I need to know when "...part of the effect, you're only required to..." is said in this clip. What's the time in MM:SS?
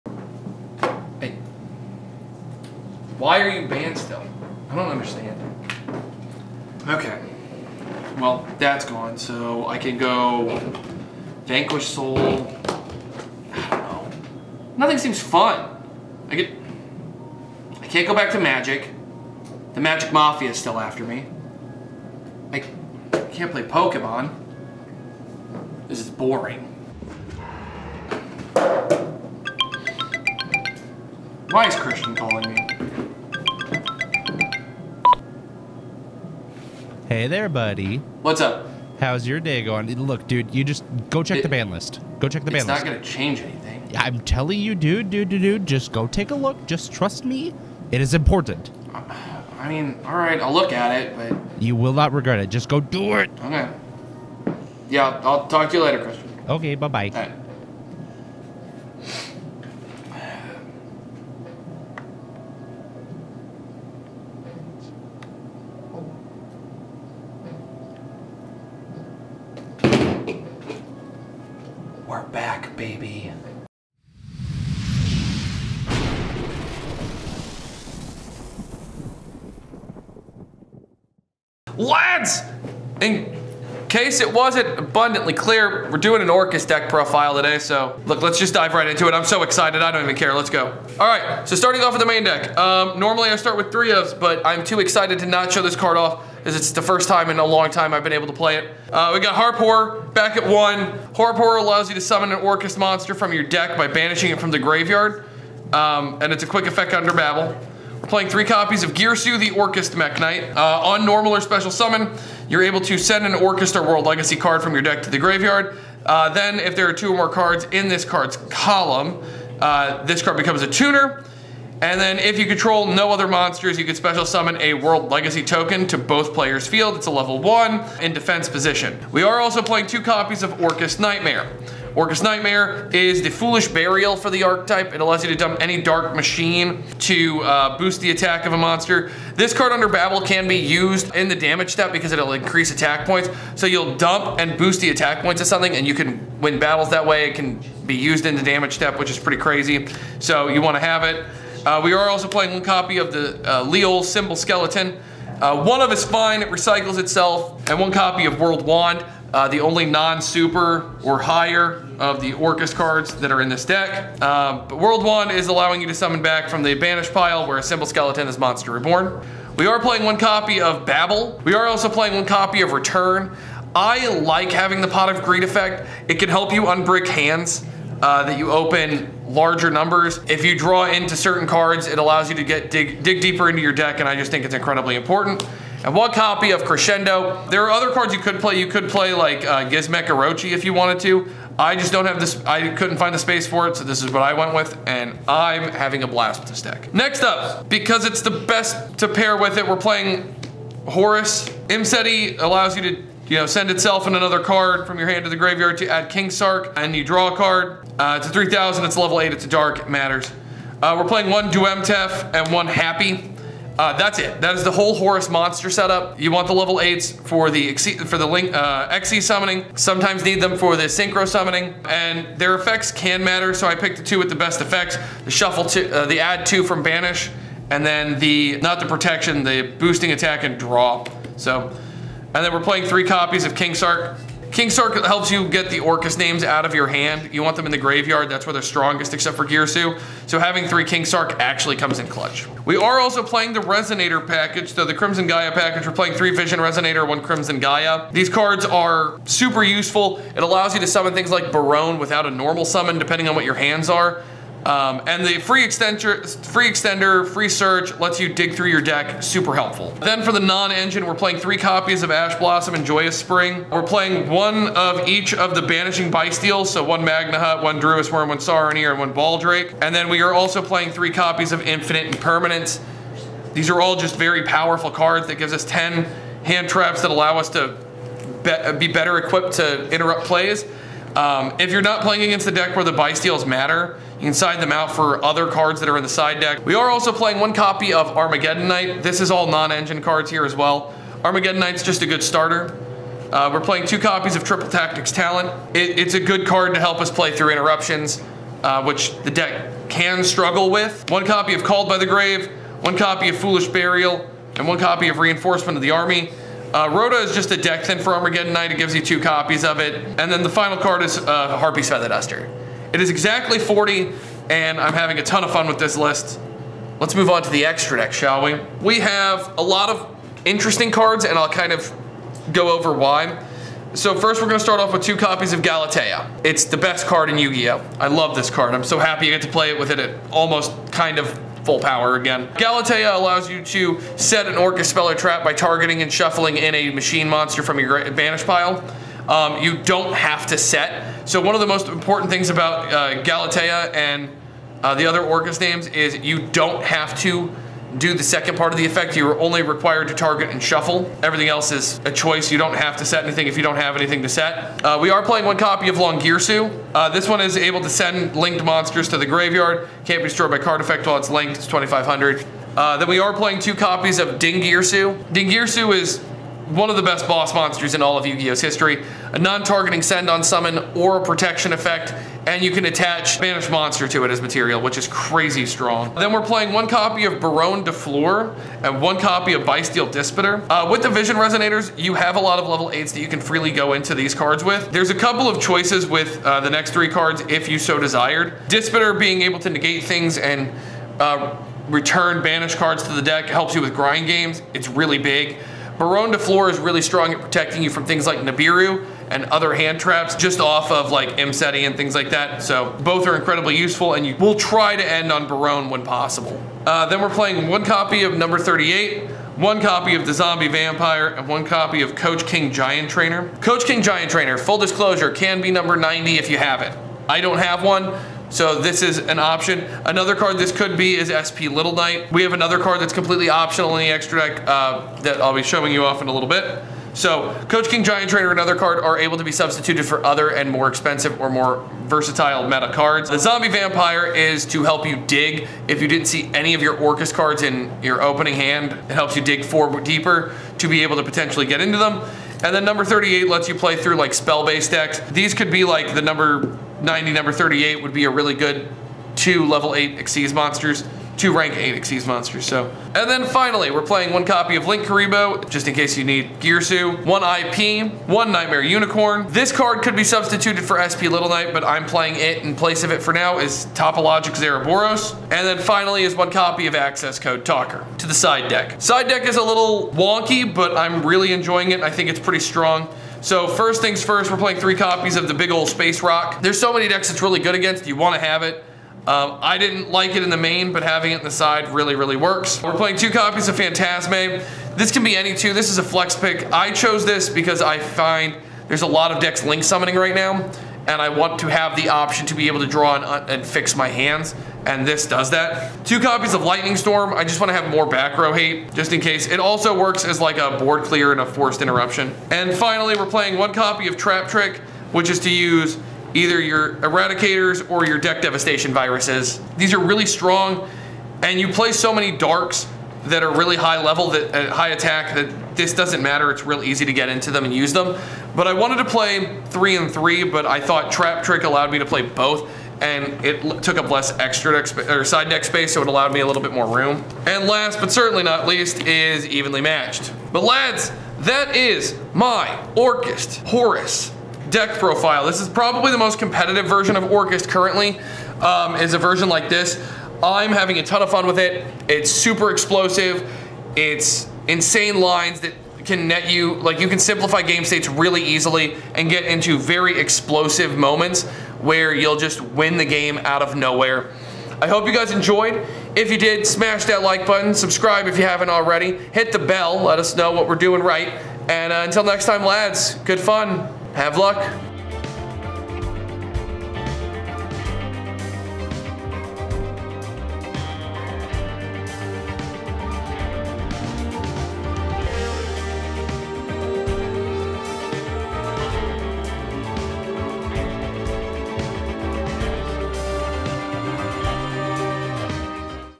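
05:48.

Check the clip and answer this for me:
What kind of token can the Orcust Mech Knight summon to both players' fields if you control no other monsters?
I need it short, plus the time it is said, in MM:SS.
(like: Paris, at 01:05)
World Legacy token, at 02:04.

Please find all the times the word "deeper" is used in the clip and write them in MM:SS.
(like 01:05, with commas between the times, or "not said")
03:03, 07:20.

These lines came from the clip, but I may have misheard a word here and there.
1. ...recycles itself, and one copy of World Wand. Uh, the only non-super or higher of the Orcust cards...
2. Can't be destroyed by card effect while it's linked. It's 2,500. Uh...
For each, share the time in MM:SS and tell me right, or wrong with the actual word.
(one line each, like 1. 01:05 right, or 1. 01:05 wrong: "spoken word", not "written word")
1. 02:36 right
2. 06:00 right.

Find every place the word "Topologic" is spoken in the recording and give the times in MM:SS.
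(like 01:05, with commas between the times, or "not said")
07:43.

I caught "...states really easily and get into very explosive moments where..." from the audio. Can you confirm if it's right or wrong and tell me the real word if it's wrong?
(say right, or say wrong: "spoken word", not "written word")
right.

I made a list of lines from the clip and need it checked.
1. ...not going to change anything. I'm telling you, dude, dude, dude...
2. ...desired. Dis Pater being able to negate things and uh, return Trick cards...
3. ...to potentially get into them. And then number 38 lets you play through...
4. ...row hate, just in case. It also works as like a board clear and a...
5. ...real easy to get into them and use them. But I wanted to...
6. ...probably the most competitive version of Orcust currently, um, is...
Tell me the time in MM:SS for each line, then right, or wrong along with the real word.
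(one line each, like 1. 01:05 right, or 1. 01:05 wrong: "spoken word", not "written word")
1. 00:42 right
2. 06:27 wrong: "Banished", not "Trick"
3. 07:21 right
4. 08:18 right
5. 08:36 right
6. 08:55 right.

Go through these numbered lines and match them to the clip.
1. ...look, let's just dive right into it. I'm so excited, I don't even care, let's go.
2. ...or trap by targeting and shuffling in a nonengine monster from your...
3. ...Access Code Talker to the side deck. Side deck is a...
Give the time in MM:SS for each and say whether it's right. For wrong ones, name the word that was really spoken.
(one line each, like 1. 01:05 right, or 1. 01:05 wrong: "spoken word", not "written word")
1. 01:28 right
2. 05:35 wrong: "machine", not "nonengine"
3. 07:46 right.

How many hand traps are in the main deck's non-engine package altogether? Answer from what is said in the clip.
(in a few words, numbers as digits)
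10.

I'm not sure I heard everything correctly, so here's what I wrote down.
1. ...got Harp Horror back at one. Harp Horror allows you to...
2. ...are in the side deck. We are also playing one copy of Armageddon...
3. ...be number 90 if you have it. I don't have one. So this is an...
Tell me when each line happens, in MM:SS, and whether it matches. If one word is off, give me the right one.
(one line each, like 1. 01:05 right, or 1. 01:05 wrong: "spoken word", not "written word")
1. 01:39 right
2. 04:45 right
3. 06:55 right.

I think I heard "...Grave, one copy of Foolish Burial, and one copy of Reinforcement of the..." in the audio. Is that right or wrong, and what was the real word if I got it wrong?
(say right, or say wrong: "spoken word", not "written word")
right.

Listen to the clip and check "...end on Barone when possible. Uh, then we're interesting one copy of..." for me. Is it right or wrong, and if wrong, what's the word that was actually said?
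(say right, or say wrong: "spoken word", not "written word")
wrong: "playing", not "interesting".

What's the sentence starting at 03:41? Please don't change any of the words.
And their effects can matter, so I picked the two with the best effects.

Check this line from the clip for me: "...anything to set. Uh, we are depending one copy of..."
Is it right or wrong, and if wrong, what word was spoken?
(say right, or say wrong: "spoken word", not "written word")
wrong: "playing", not "depending".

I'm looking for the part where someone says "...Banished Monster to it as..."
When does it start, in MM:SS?
06:13.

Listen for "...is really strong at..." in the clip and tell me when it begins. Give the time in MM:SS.
06:36.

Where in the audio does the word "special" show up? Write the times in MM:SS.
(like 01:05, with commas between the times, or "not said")
01:51, 02:03.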